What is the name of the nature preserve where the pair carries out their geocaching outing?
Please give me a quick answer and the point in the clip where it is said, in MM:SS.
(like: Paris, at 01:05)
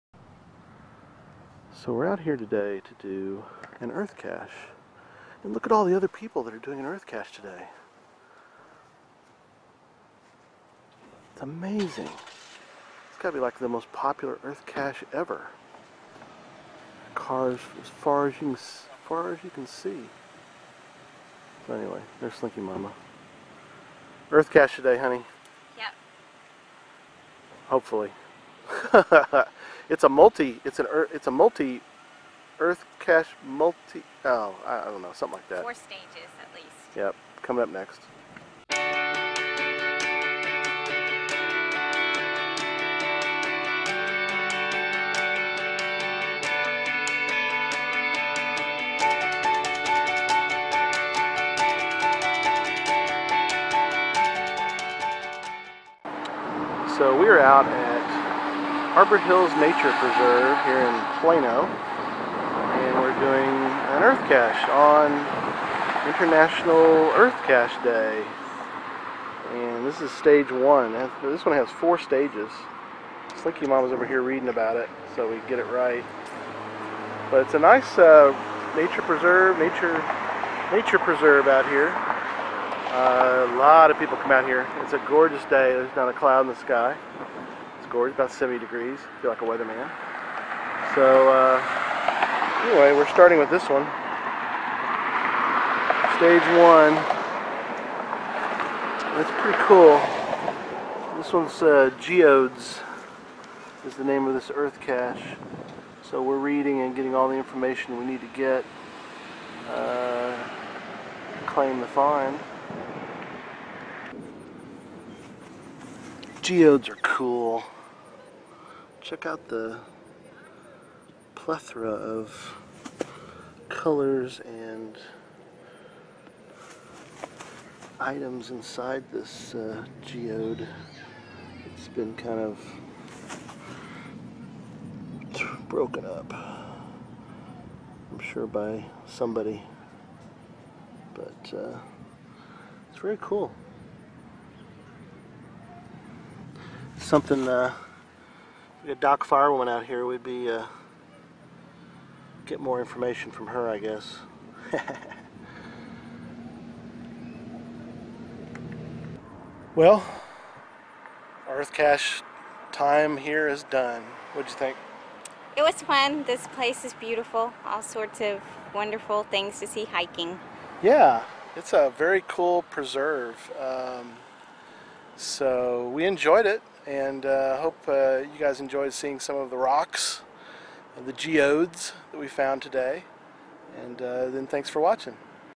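Arbor Hills Nature Preserve, at 00:58.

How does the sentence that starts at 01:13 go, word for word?
Slinky Mom is over here reading about it, so we get it right.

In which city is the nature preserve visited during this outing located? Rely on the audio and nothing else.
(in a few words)
Plano.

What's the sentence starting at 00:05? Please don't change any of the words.
And look at all the other people that are doing an earth cache today.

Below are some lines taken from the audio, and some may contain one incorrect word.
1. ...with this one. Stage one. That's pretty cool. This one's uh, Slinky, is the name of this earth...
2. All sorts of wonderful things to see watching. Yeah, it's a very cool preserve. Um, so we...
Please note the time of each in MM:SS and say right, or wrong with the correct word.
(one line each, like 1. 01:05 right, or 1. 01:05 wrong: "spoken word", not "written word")
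1. 01:33 wrong: "Geodes", not "Slinky"
2. 02:47 wrong: "hiking", not "watching".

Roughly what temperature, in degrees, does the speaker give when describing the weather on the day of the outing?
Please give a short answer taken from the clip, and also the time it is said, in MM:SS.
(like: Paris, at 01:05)
70, at 01:28.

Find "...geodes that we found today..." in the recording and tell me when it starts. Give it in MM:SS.
03:01.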